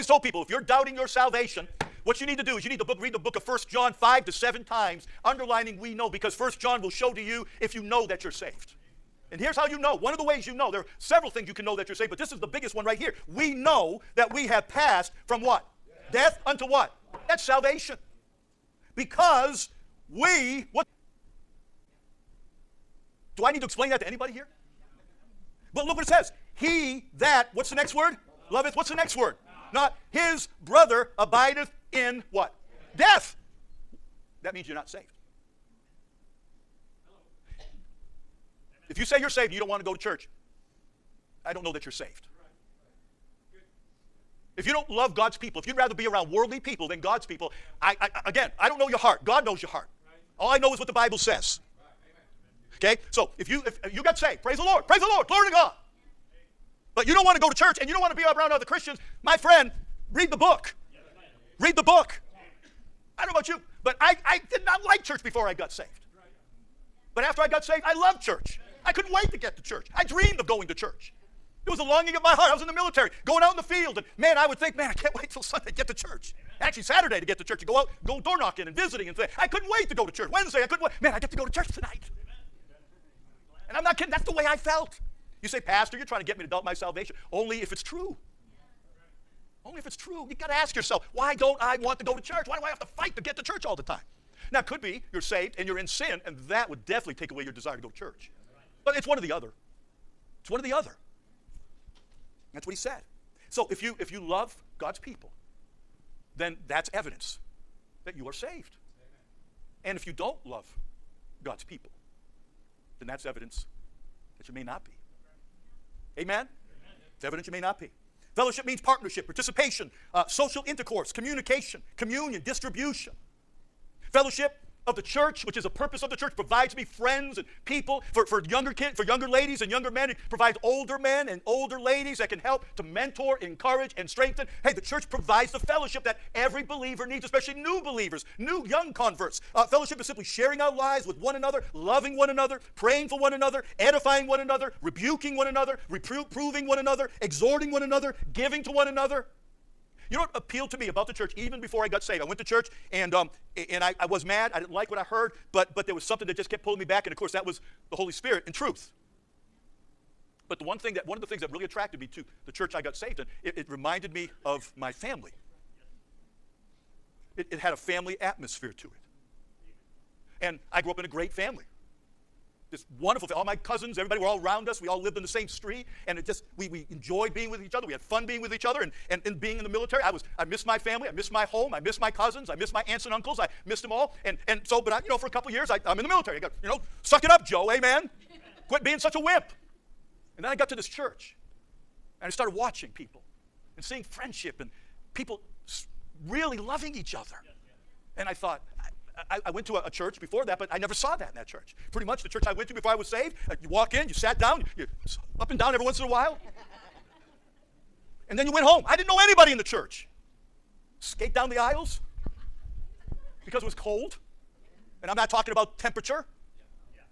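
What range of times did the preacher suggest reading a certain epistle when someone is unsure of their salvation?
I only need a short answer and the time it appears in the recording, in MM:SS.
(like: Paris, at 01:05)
5 to 7, at 00:03.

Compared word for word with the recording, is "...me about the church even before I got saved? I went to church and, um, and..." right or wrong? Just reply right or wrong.
right.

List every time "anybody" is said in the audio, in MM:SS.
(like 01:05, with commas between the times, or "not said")
00:24, 03:29.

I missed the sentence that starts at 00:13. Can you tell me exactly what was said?
We know that we have passed from what?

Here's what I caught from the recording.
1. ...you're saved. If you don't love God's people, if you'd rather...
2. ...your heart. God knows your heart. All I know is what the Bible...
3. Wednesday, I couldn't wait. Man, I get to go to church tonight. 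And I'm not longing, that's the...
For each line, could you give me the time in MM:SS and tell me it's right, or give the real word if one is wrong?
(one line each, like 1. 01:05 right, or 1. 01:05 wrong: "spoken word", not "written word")
1. 00:41 right
2. 00:48 right
3. 01:20 wrong: "kidding", not "longing".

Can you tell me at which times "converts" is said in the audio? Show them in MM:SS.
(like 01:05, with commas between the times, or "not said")
02:18.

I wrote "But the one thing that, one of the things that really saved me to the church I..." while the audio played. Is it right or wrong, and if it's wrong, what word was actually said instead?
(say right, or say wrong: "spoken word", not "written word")
wrong: "attracted", not "saved".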